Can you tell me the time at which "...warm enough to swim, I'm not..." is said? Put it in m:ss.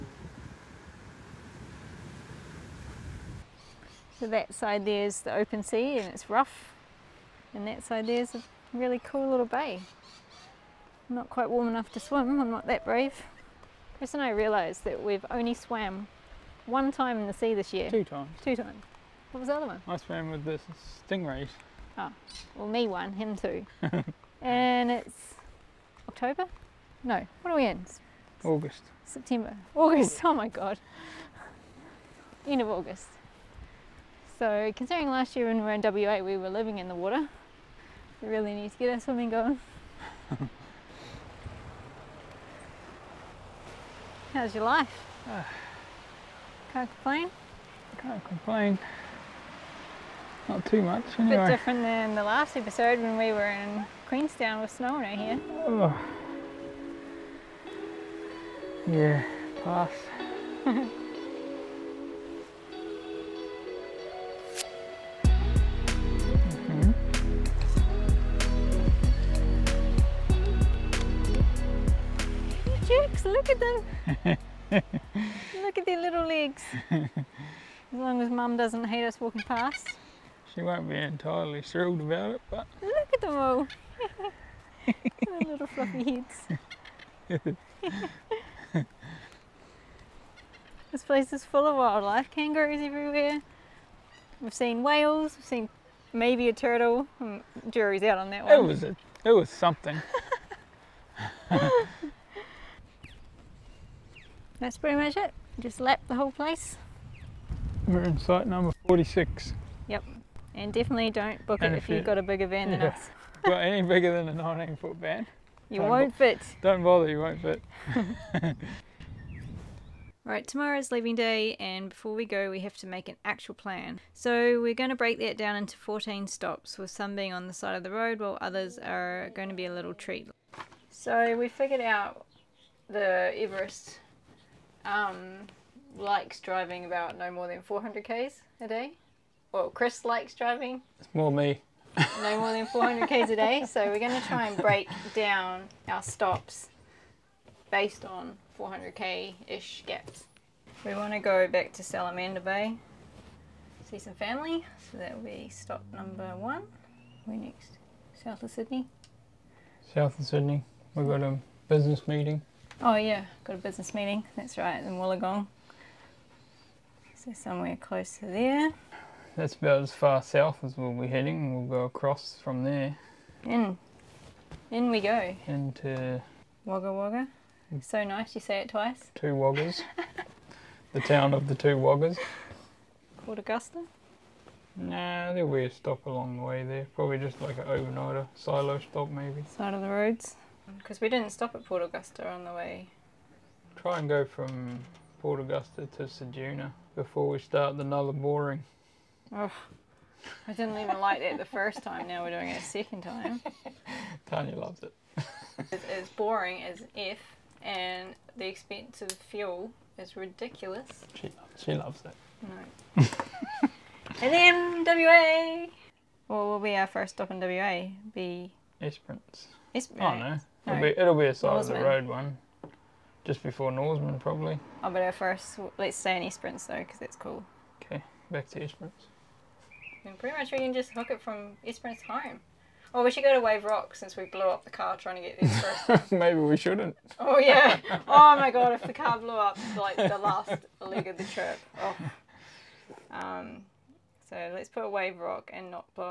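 0:11.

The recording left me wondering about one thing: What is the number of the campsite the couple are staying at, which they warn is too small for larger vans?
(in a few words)
46.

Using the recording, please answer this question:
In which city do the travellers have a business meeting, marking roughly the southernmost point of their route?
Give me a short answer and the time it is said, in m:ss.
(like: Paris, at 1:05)
Wollongong, at 2:44.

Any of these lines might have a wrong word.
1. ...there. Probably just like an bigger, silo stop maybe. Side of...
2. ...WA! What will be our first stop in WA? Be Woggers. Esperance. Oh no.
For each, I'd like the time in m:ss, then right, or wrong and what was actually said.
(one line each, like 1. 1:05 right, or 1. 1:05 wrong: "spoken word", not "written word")
1. 3:06 wrong: "overnighter", not "bigger"
2. 3:34 wrong: "Esperance", not "Woggers".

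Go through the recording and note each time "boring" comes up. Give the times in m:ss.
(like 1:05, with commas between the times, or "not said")
3:18, 3:26.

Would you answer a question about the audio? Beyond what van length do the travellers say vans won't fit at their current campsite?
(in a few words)
19 foot.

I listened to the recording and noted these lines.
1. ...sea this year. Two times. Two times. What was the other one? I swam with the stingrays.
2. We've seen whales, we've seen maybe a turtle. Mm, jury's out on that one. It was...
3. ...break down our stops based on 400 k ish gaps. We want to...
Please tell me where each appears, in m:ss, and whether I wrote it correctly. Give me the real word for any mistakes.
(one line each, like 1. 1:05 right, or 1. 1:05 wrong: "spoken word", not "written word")
1. 0:17 right
2. 1:34 right
3. 2:24 right.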